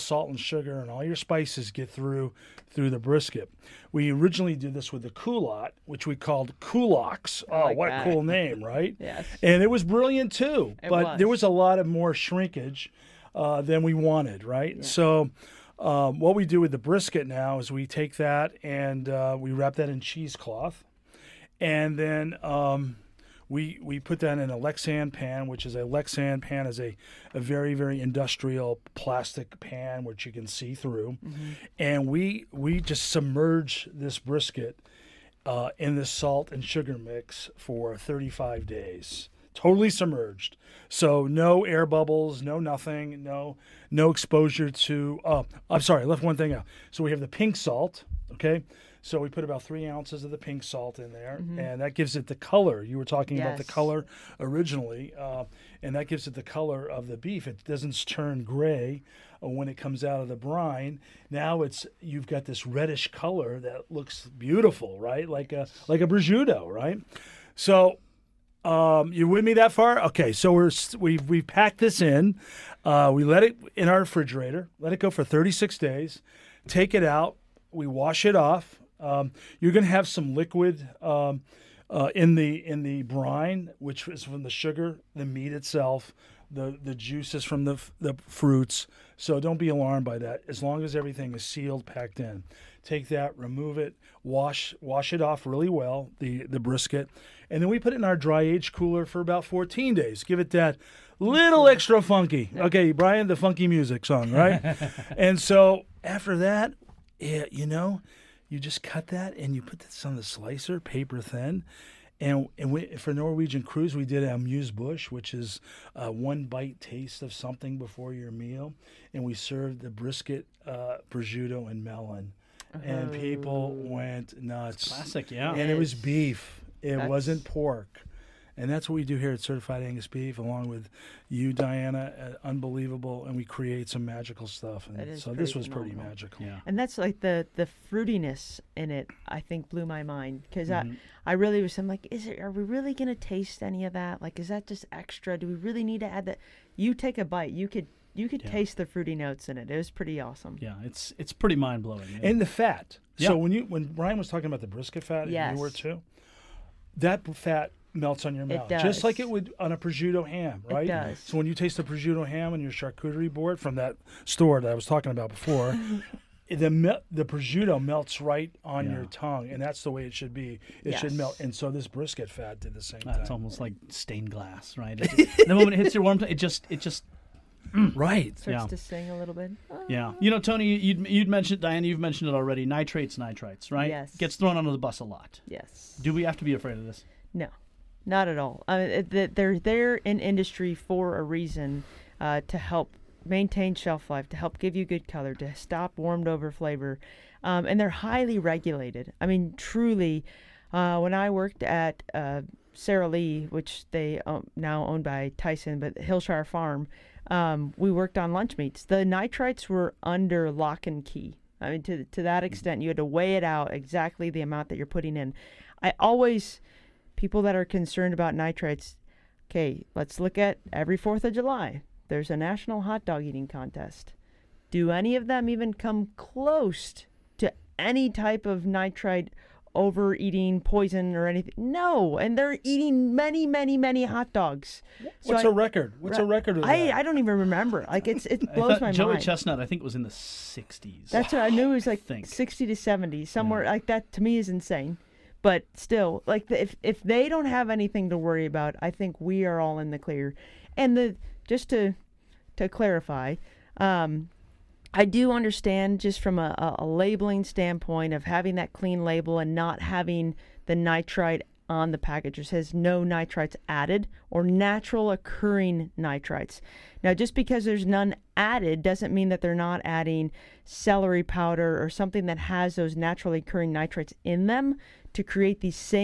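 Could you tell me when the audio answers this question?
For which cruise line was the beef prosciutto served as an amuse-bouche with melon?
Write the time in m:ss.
1:53.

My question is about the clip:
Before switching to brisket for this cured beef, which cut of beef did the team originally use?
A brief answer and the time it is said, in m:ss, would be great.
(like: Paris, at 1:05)
culotte, at 0:05.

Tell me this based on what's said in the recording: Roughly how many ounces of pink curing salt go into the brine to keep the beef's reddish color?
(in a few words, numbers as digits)
3.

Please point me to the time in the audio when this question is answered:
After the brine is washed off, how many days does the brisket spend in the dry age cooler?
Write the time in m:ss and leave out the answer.
1:39.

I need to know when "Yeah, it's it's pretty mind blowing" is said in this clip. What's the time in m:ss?
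2:30.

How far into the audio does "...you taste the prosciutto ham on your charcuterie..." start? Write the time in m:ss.
2:41.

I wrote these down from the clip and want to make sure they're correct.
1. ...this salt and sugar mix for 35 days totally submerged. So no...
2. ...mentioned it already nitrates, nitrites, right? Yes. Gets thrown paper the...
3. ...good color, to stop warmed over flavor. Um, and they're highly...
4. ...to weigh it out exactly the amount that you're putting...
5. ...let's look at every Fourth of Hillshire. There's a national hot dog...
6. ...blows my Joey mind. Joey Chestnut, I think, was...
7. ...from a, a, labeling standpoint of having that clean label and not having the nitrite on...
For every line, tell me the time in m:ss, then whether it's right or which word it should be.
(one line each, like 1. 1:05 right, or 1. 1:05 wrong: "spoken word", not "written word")
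1. 0:35 right
2. 3:01 wrong: "under", not "paper"
3. 3:14 right
4. 3:32 right
5. 3:39 wrong: "July", not "Hillshire"
6. 3:58 right
7. 4:16 right.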